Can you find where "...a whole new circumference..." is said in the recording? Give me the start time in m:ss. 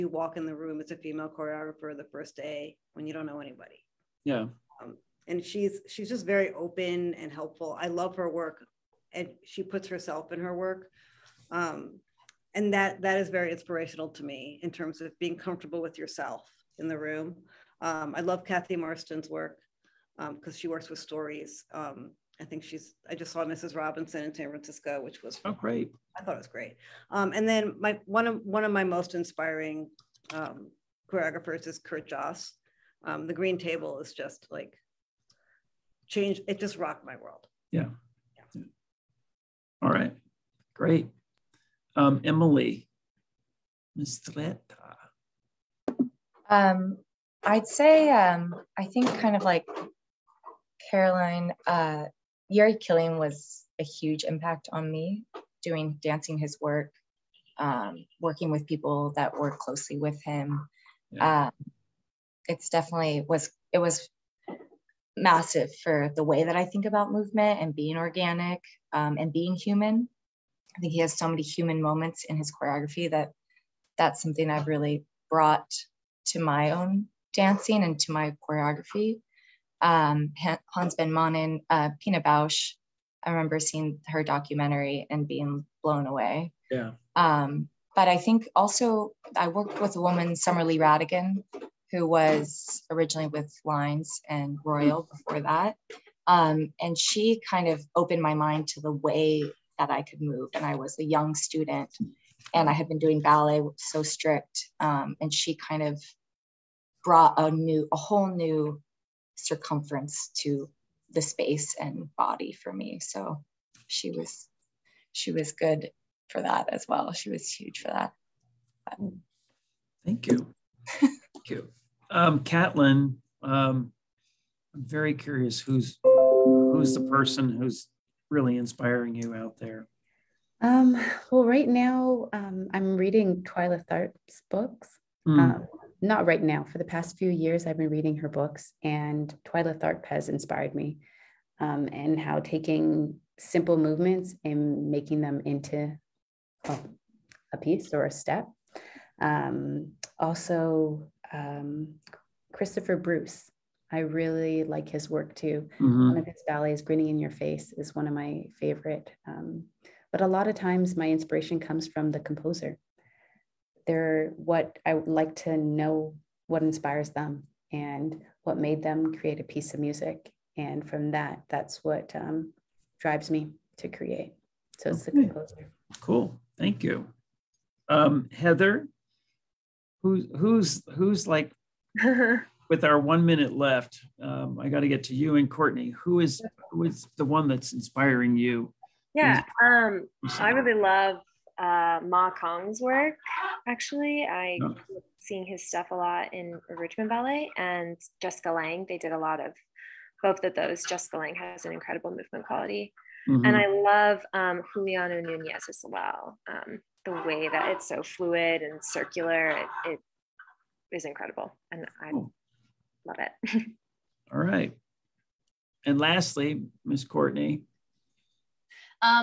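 1:47.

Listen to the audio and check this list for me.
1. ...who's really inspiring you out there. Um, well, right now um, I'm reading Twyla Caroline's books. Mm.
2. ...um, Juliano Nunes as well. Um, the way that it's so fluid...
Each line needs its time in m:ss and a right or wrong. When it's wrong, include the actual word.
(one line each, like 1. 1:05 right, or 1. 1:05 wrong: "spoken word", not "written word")
1. 2:07 wrong: "Tharp", not "Caroline"
2. 3:24 right.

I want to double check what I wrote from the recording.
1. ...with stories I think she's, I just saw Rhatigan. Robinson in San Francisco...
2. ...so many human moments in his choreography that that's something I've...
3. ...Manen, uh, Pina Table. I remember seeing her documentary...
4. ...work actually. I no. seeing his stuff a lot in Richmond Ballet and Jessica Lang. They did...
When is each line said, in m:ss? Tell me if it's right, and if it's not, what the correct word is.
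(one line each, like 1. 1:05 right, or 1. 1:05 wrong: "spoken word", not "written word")
1. 0:20 wrong: "Mrs", not "Rhatigan"
2. 1:11 right
3. 1:21 wrong: "Bausch", not "Table"
4. 3:12 right.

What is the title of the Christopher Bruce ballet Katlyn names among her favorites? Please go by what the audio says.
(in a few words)
Grinning in Your Face.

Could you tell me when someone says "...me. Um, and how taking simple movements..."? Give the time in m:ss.
2:20.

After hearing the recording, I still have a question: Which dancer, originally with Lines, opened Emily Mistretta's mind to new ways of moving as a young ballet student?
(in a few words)
Summer Lee Rhatigan.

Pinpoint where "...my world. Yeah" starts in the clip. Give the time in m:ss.
0:37.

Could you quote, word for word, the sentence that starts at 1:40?
And I was a young student and I had been doing ballet so strict.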